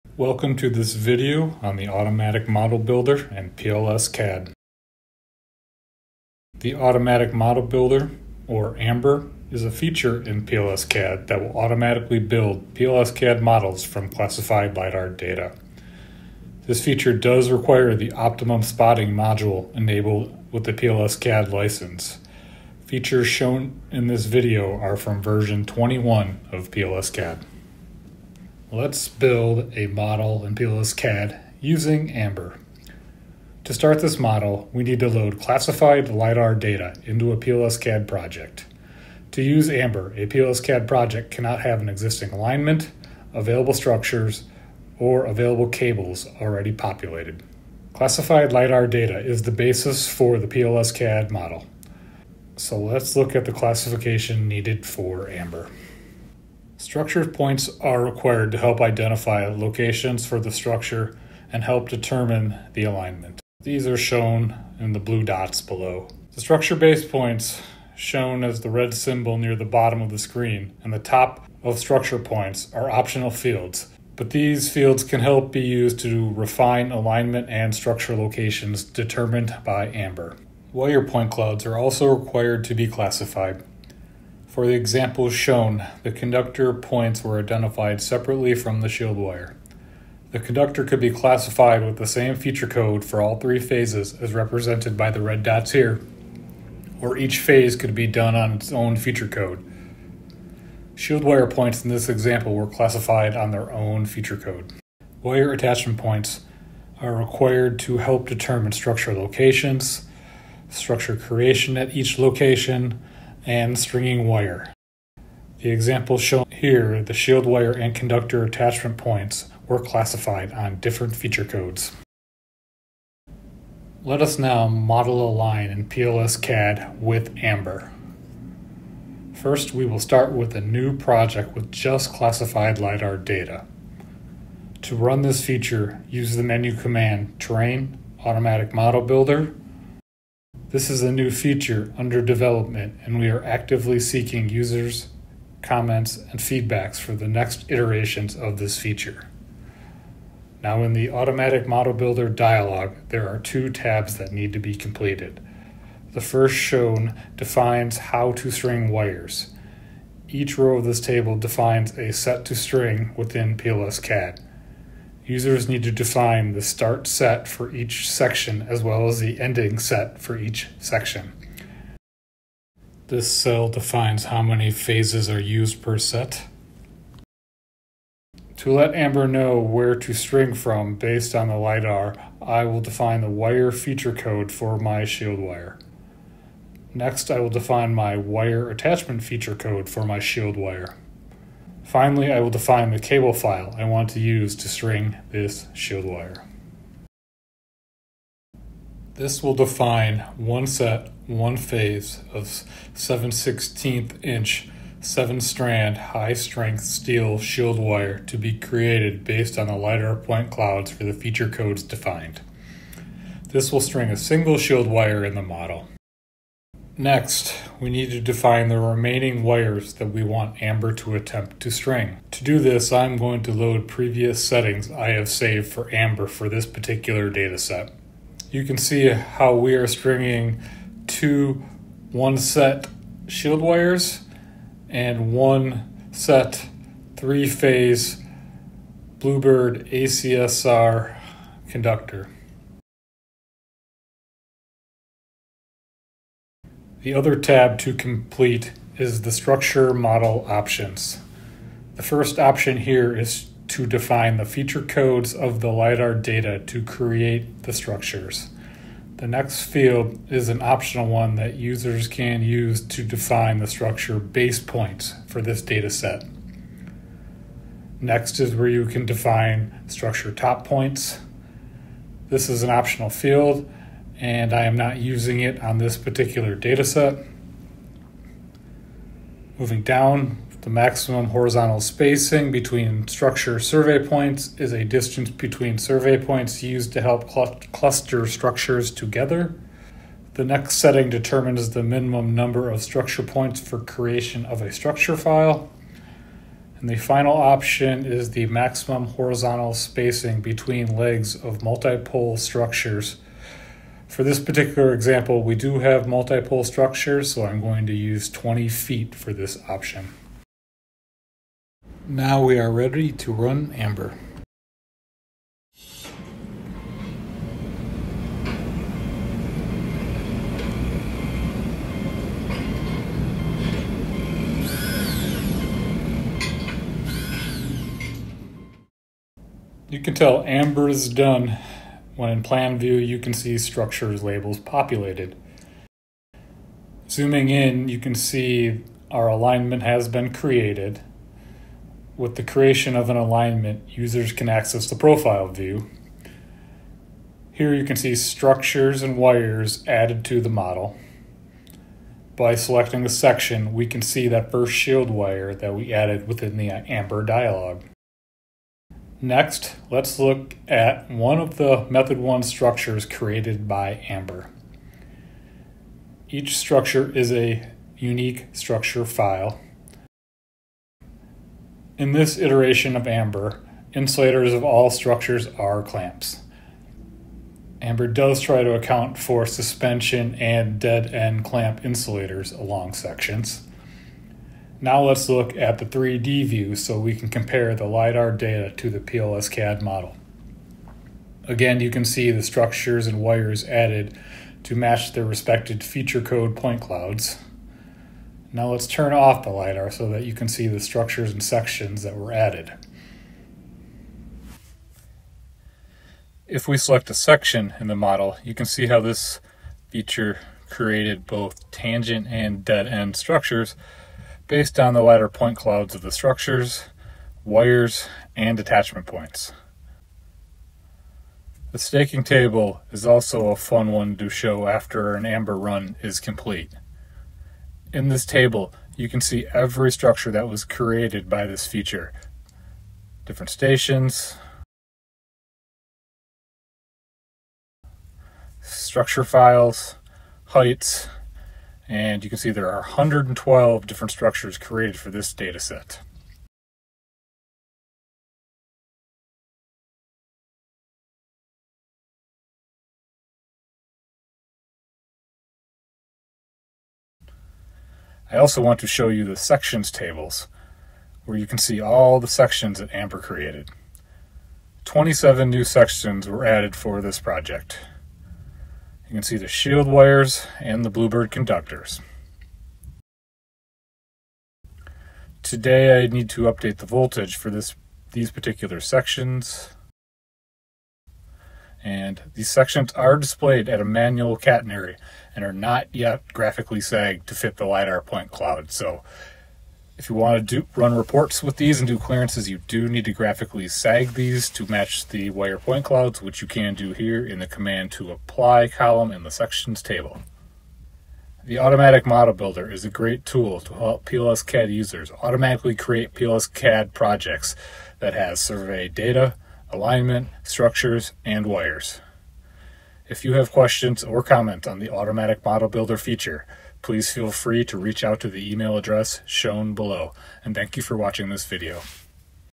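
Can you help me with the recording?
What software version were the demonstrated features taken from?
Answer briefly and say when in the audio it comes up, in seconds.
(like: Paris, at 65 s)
21, at 25 s.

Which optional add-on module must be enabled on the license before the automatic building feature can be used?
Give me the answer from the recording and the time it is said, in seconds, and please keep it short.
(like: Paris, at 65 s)
optimum spotting module, at 18 s.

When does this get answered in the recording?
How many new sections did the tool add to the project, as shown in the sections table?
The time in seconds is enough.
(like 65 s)
464 s.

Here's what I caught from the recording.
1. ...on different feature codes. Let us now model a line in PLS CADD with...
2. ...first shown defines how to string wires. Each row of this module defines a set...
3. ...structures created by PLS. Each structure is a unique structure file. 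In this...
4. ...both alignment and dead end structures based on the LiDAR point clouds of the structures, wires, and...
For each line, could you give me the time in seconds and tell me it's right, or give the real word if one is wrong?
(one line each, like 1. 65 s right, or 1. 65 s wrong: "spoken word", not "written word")
1. 120 s right
2. 156 s wrong: "table", not "module"
3. 362 s wrong: "Amber", not "PLS"
4. 411 s wrong: "tangent", not "alignment".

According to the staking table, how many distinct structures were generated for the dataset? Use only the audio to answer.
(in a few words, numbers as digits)
112.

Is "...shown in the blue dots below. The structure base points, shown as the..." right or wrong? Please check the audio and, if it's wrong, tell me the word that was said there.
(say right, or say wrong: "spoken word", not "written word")
right.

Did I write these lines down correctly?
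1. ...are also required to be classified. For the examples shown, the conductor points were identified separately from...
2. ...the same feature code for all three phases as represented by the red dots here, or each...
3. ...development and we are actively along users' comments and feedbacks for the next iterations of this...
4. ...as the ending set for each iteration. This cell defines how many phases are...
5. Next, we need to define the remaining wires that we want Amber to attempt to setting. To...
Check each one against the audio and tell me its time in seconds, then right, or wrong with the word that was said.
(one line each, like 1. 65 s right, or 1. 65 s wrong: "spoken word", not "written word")
1. 81 s right
2. 91 s right
3. 142 s wrong: "seeking", not "along"
4. 169 s wrong: "section", not "iteration"
5. 216 s wrong: "string", not "setting".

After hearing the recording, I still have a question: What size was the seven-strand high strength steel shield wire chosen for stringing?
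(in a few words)
7/16 inch.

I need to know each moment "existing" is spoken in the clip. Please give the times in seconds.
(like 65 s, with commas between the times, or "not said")
41 s.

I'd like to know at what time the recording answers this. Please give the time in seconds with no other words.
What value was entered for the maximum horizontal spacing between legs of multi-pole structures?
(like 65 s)
308 s.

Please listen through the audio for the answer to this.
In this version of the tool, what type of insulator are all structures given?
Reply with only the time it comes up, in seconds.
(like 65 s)
375 s.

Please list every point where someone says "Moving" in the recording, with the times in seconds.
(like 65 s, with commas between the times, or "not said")
279 s.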